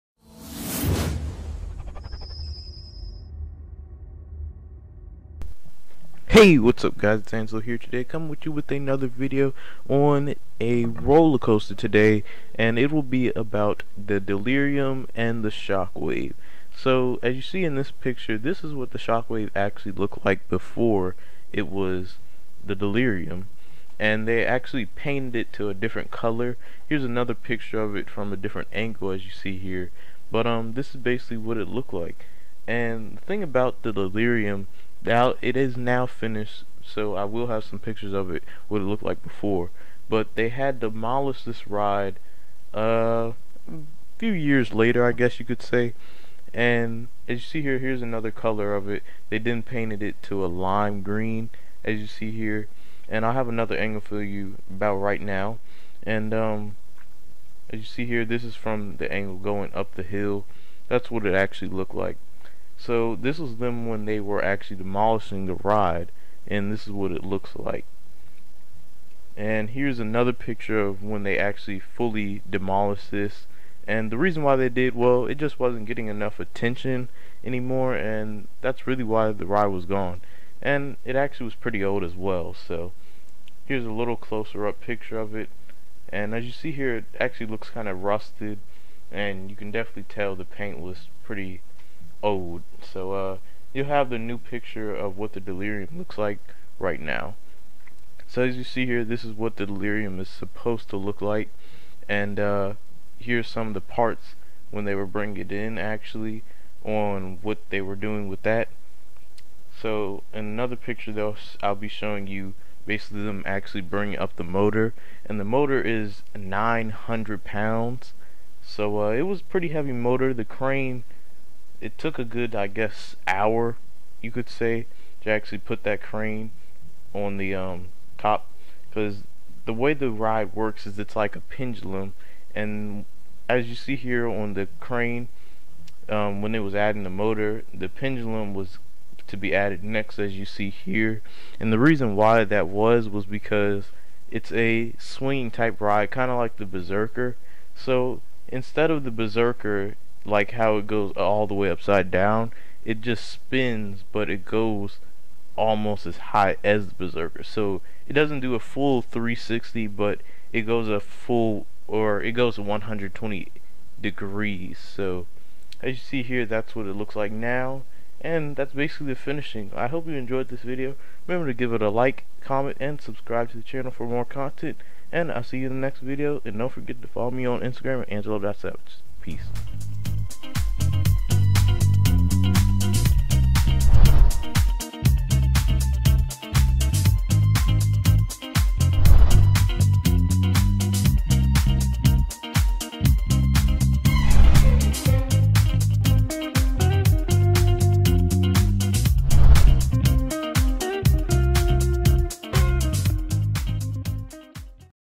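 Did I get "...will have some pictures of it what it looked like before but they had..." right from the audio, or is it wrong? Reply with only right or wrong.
right.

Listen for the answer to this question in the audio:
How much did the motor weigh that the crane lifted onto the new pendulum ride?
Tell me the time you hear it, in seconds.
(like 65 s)
116 s.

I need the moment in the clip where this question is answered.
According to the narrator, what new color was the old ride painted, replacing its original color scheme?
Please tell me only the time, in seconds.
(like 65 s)
50 s.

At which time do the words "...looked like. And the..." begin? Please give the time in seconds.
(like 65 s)
31 s.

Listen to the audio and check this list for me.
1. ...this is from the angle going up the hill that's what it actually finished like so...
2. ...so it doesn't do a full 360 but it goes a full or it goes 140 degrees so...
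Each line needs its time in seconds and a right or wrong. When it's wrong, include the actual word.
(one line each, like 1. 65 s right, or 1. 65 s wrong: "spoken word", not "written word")
1. 58 s wrong: "looked", not "finished"
2. 157 s wrong: "120", not "140".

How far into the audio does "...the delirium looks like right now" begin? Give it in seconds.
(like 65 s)
95 s.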